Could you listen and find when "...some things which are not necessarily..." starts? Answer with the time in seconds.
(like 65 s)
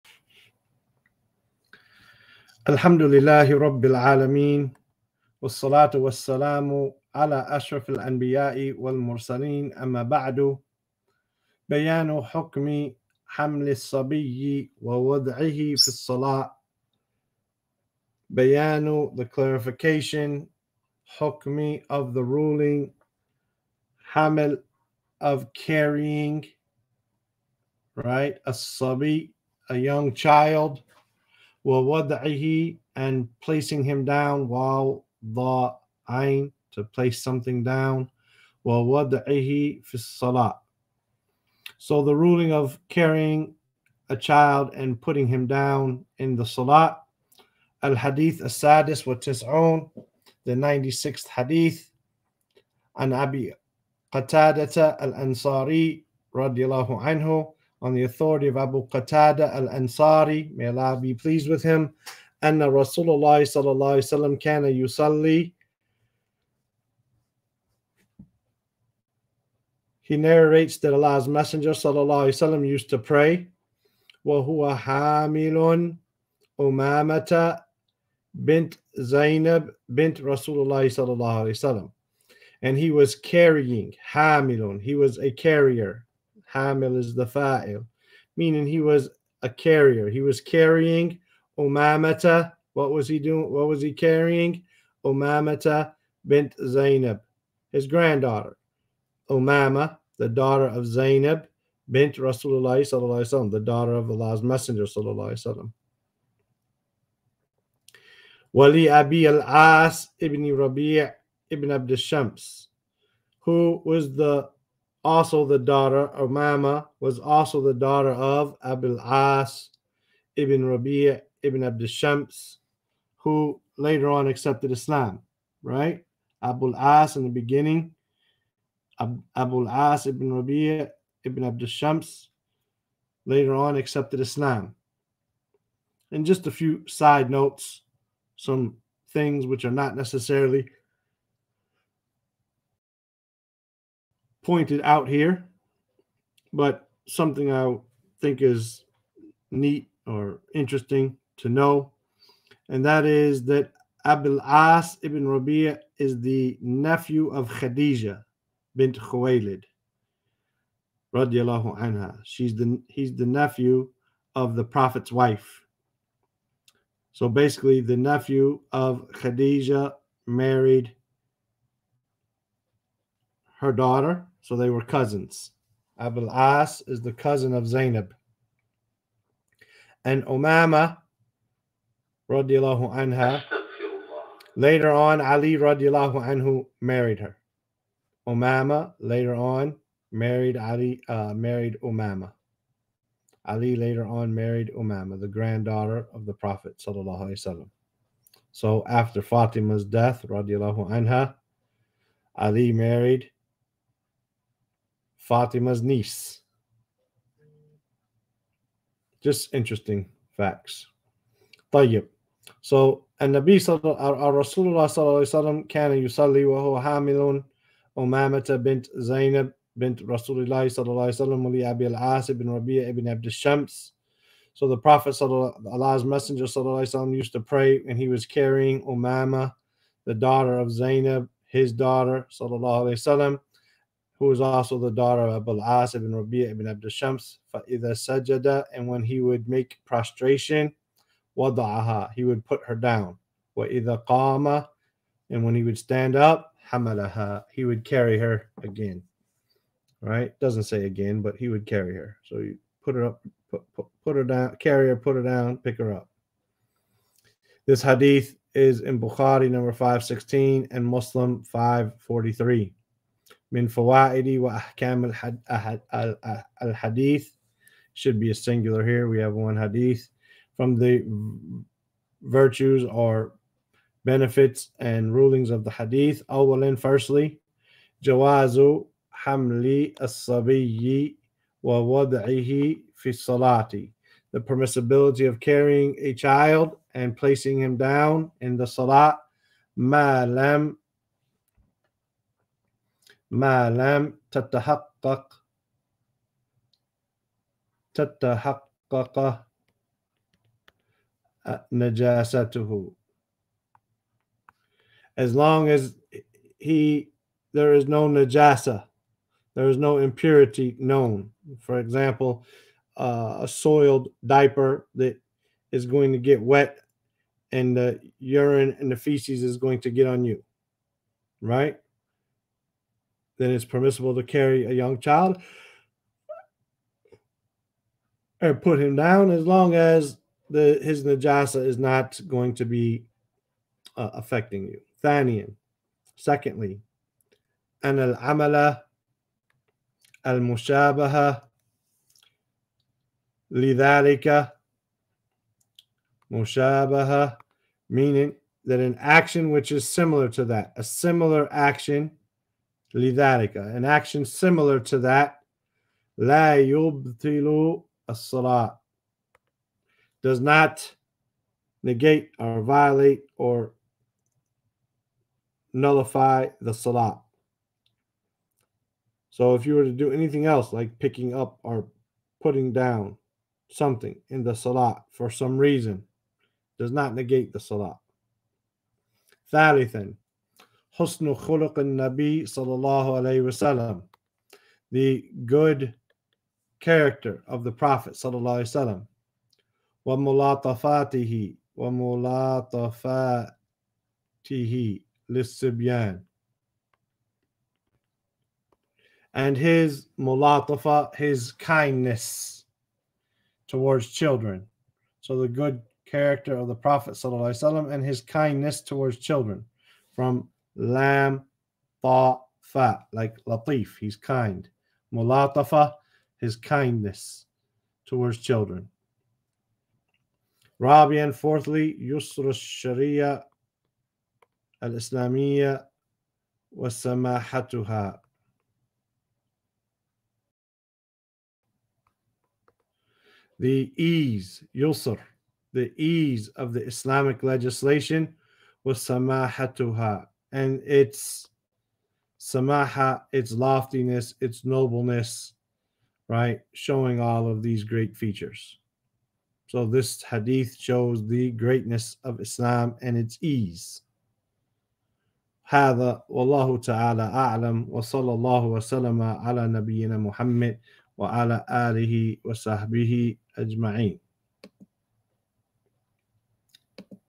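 138 s.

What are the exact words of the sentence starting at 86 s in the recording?
Hamil is the fa'il, meaning he was a carrier.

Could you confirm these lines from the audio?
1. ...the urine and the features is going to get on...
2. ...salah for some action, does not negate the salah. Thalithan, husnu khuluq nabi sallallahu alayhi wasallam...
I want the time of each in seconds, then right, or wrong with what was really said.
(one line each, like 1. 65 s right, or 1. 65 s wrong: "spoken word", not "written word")
1. 317 s wrong: "feces", not "features"
2. 374 s wrong: "reason", not "action".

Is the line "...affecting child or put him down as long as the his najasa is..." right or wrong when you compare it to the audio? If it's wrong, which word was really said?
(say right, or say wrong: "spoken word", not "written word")
wrong: "young", not "affecting".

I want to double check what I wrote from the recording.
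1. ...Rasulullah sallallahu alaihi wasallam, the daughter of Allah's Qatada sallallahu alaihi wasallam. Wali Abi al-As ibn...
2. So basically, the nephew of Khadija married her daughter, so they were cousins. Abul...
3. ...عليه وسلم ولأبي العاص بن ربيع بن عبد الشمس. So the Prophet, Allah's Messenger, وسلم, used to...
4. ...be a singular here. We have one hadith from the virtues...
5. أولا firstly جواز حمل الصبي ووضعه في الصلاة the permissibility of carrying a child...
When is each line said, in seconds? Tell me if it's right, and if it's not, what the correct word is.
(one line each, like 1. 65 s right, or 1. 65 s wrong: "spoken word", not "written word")
1. 102 s wrong: "Messenger", not "Qatada"
2. 167 s right
3. 221 s right
4. 268 s right
5. 276 s right.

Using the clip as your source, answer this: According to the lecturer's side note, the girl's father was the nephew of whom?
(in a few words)
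Khadija bint Khuwaylid.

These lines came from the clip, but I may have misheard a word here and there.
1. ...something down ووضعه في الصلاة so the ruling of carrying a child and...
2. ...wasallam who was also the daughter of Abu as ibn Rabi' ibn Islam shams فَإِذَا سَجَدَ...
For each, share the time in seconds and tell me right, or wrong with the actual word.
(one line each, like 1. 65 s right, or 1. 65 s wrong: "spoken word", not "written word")
1. 37 s right
2. 232 s wrong: "Abd", not "Islam".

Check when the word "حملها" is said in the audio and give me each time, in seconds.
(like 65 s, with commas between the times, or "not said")
246 s.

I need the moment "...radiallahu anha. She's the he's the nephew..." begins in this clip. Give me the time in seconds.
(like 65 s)
161 s.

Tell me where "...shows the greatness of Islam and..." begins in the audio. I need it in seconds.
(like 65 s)
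450 s.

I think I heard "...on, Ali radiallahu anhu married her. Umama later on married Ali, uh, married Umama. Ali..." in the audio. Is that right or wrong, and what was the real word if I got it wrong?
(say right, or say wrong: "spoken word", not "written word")
right.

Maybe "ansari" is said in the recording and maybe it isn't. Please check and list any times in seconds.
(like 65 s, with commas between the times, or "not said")
54 s, 59 s.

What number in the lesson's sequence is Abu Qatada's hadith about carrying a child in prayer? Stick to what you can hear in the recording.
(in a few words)
96.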